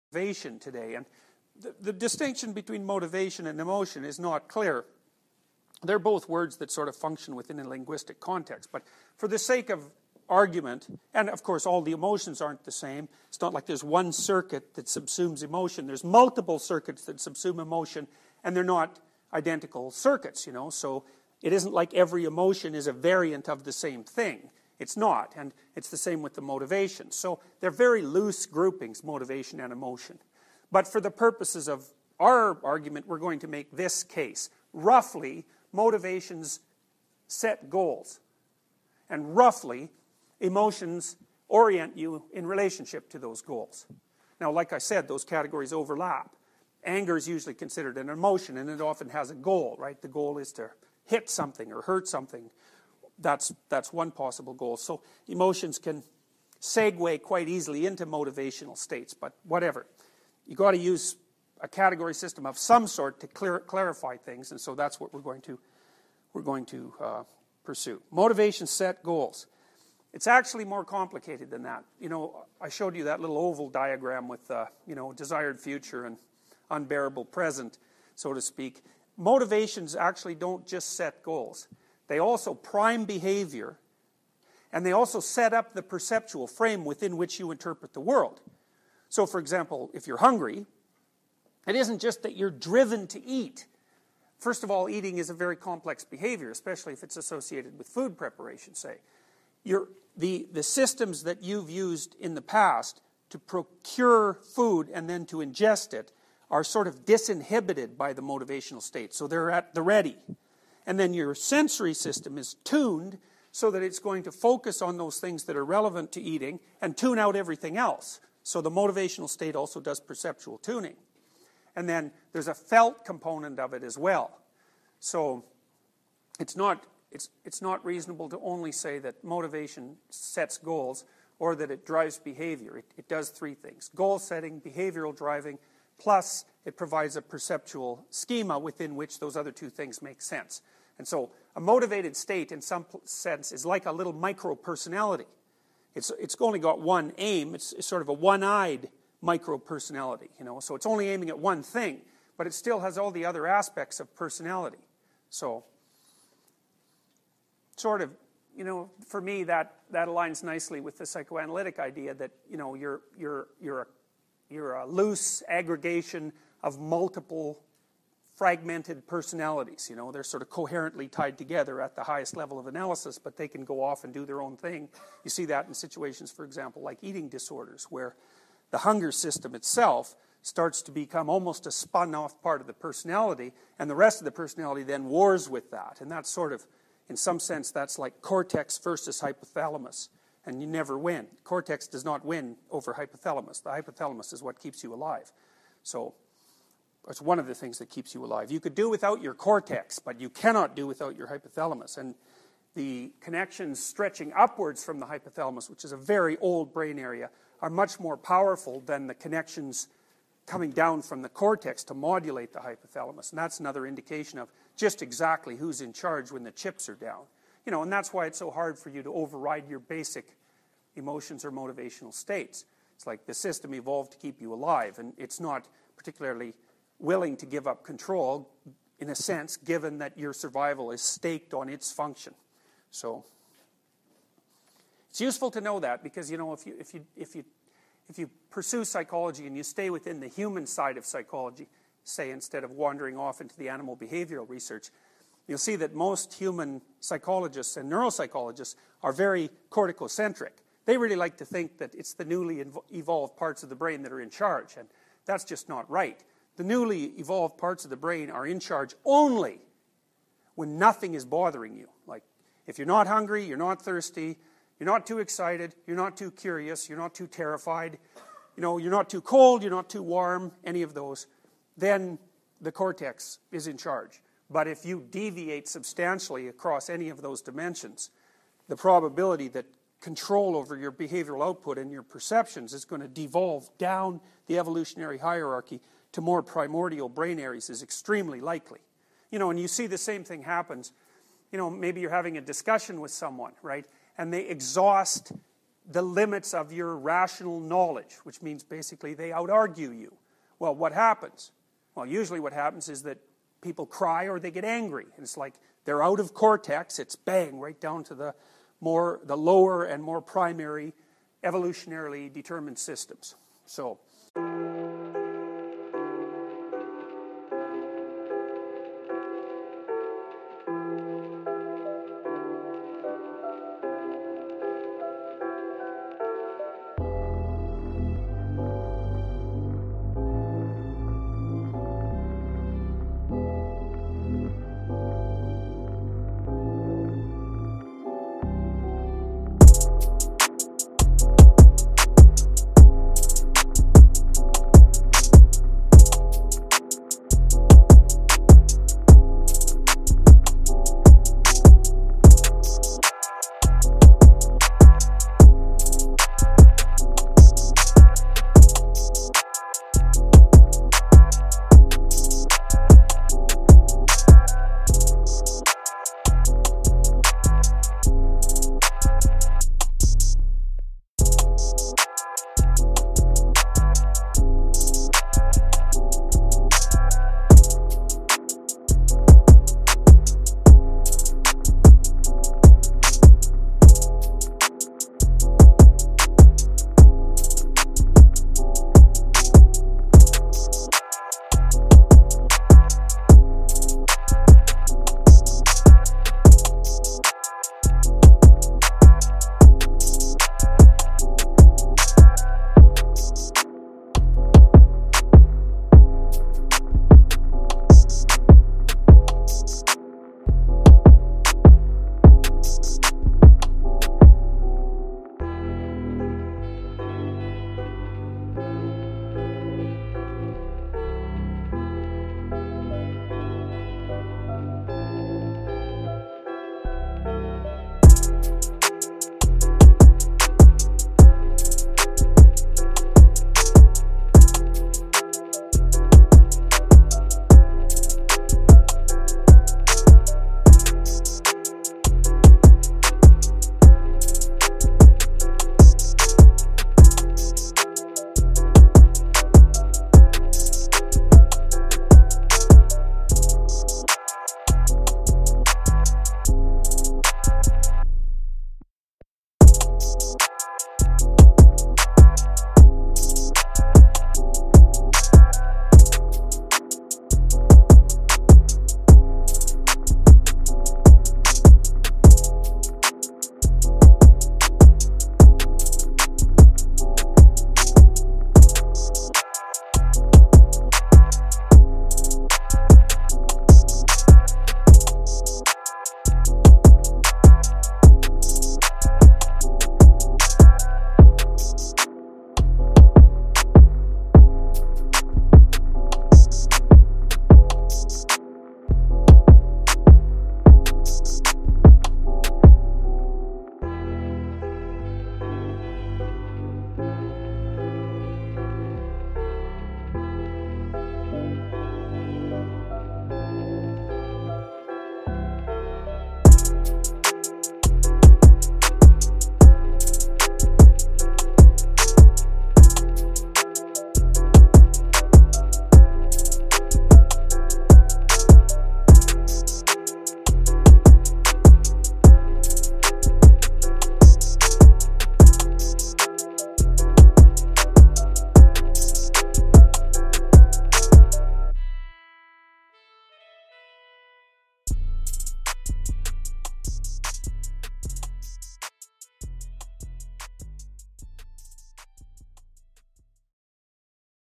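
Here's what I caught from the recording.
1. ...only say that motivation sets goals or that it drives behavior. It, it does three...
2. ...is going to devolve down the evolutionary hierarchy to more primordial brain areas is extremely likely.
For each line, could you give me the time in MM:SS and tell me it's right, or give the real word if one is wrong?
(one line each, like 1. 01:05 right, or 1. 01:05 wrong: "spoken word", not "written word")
1. 02:08 right
2. 04:42 right.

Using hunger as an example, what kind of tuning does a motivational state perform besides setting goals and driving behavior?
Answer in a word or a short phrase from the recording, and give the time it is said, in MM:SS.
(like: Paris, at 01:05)
Perceptual tuning, at 01:59.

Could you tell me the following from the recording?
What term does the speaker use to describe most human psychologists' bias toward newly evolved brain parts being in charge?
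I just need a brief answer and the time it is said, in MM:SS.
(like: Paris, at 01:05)
Corticocentric, at 04:09.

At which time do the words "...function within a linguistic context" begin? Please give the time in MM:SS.
00:06.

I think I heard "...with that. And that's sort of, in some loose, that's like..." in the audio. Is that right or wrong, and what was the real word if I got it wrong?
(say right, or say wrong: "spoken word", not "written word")
wrong: "sense", not "loose".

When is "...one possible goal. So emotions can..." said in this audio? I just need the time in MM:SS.
00:53.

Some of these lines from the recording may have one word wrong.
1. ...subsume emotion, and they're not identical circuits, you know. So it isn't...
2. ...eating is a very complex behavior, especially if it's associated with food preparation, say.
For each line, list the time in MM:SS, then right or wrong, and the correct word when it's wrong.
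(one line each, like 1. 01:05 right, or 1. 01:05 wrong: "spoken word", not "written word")
1. 00:17 right
2. 01:34 right.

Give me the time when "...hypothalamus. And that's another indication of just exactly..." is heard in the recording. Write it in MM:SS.
03:32.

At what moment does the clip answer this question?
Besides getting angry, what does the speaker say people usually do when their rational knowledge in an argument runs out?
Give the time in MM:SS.
05:03.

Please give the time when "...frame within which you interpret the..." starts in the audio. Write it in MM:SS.
01:26.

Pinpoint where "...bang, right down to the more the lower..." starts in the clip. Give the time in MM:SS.
05:07.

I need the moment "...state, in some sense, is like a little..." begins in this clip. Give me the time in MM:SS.
02:22.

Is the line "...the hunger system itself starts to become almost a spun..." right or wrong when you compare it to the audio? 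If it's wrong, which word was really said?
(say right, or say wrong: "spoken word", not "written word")
right.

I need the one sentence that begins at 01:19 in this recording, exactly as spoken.
Motivations actually don't just set goals.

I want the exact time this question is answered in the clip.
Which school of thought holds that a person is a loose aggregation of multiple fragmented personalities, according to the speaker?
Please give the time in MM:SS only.
02:41.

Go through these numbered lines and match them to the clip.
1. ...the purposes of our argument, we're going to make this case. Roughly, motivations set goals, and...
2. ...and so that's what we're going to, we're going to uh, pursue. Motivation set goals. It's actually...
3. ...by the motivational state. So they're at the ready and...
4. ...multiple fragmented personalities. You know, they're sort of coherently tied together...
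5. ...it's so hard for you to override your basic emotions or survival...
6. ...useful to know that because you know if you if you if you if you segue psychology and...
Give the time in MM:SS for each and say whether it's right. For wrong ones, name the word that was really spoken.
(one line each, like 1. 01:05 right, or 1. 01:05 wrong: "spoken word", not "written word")
1. 00:30 right
2. 01:04 right
3. 01:47 right
4. 02:46 right
5. 03:38 wrong: "motivational", not "survival"
6. 03:55 wrong: "pursue", not "segue".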